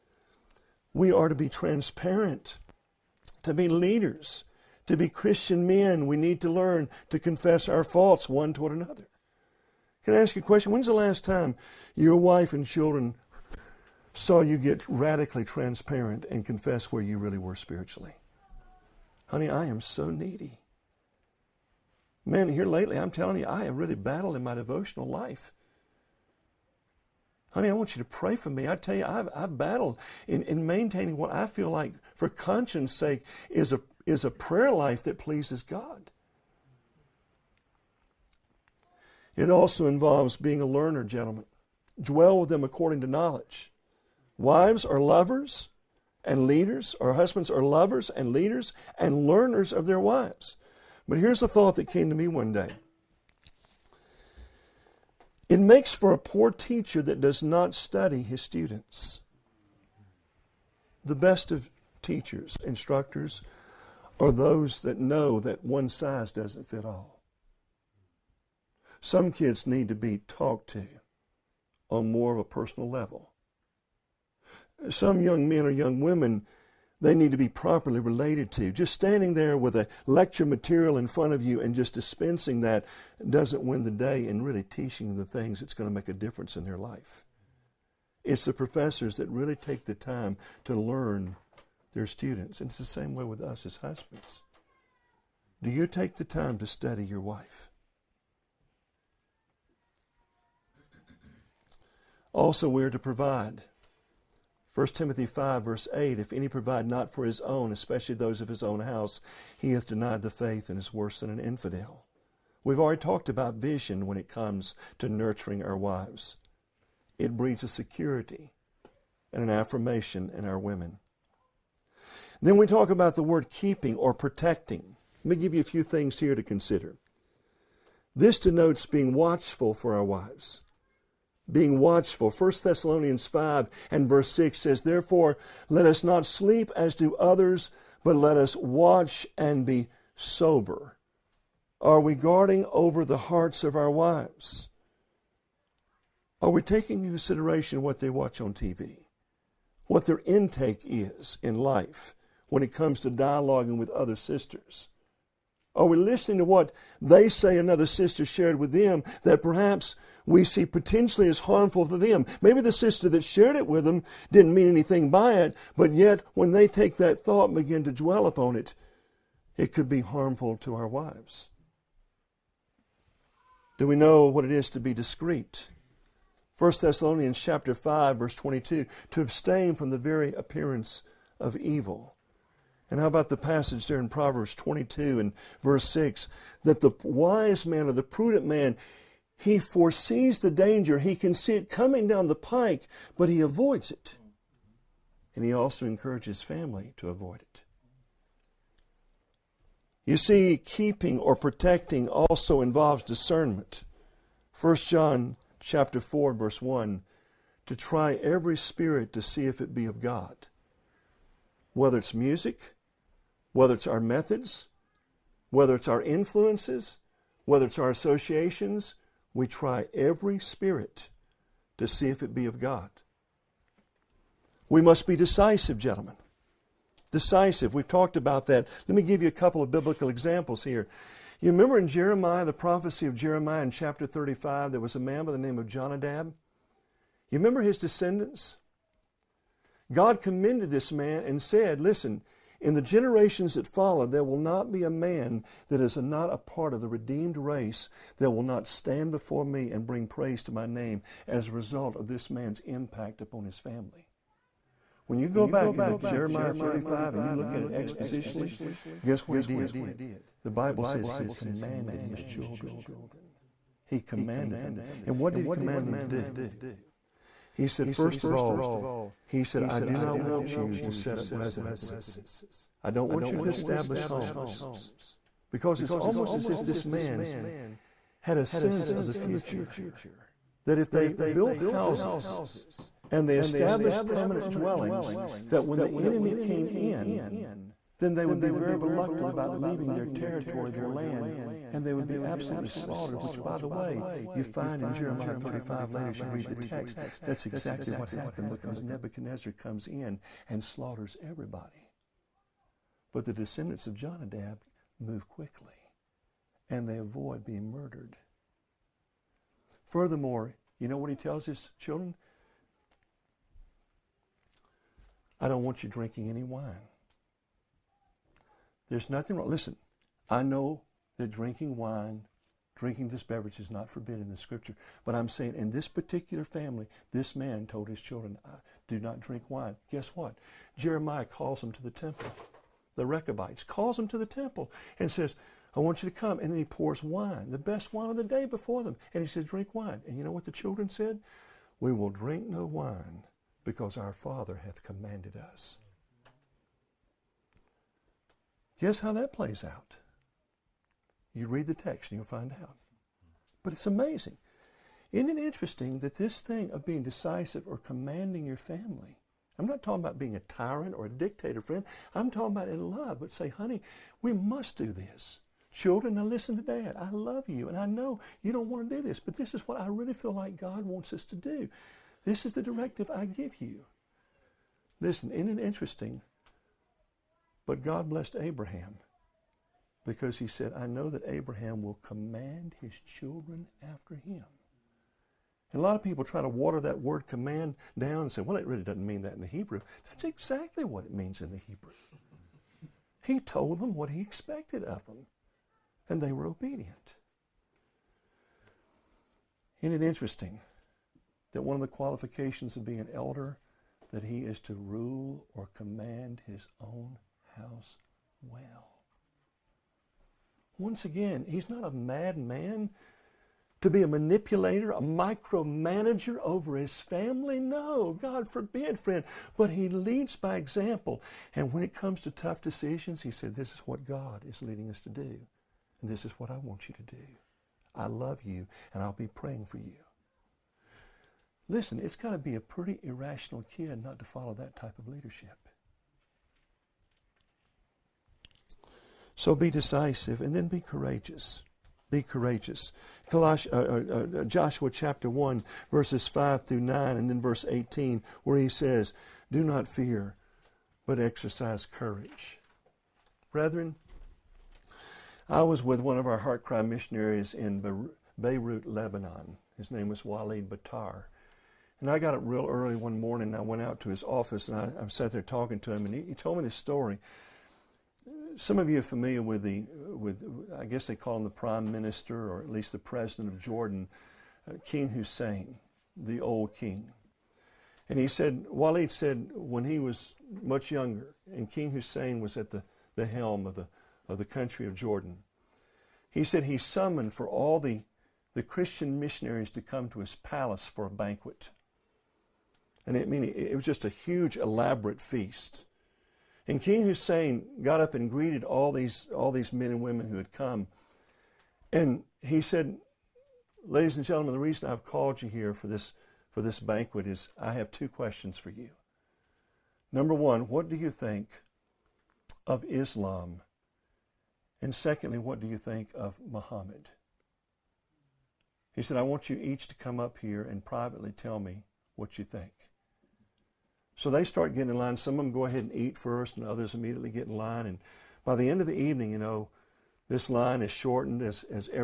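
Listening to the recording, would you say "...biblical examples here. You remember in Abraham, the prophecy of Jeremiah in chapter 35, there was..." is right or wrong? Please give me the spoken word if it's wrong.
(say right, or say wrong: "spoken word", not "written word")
wrong: "Jeremiah", not "Abraham".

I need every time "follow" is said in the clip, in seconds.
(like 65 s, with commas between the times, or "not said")
243 s, 434 s.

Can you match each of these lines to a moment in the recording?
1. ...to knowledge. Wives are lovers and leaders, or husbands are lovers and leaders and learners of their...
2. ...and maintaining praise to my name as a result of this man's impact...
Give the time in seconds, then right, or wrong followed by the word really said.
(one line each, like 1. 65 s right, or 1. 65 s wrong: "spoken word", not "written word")
1. 43 s right
2. 249 s wrong: "bring", not "maintaining".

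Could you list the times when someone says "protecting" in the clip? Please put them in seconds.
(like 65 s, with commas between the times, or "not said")
124 s, 201 s.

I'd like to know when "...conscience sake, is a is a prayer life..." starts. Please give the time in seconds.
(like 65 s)
32 s.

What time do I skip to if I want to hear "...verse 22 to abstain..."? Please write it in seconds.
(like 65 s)
178 s.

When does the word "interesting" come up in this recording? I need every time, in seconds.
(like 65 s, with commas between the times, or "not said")
355 s, 375 s, 400 s.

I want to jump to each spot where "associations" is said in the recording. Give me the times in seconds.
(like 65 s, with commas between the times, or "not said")
217 s.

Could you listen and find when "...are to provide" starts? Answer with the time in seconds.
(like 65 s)
102 s.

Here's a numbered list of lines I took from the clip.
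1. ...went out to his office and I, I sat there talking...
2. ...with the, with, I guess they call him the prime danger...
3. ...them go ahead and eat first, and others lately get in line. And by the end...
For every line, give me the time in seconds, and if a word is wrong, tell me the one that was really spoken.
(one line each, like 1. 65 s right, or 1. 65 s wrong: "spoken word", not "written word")
1. 463 s right
2. 469 s wrong: "minister", not "danger"
3. 525 s wrong: "immediately", not "lately".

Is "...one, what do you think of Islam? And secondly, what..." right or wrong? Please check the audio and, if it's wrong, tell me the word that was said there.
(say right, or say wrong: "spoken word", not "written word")
right.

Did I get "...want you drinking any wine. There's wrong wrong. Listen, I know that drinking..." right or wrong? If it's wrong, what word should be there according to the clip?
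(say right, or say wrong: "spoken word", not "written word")
wrong: "nothing", not "wrong".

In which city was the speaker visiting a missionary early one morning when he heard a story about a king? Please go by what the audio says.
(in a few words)
Beirut, Lebanon.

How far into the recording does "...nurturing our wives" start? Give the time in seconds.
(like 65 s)
115 s.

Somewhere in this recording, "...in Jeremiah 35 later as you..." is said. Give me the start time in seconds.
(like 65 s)
294 s.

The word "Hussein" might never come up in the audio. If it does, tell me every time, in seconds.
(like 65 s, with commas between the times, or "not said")
475 s, 481 s, 497 s.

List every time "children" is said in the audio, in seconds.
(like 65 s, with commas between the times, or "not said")
12 s, 262 s, 311 s, 328 s, 340 s, 365 s, 383 s.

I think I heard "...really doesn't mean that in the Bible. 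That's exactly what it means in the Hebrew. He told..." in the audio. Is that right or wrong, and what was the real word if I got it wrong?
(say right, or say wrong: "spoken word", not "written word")
wrong: "Hebrew", not "Bible".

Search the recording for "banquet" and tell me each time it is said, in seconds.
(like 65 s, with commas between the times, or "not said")
491 s, 506 s.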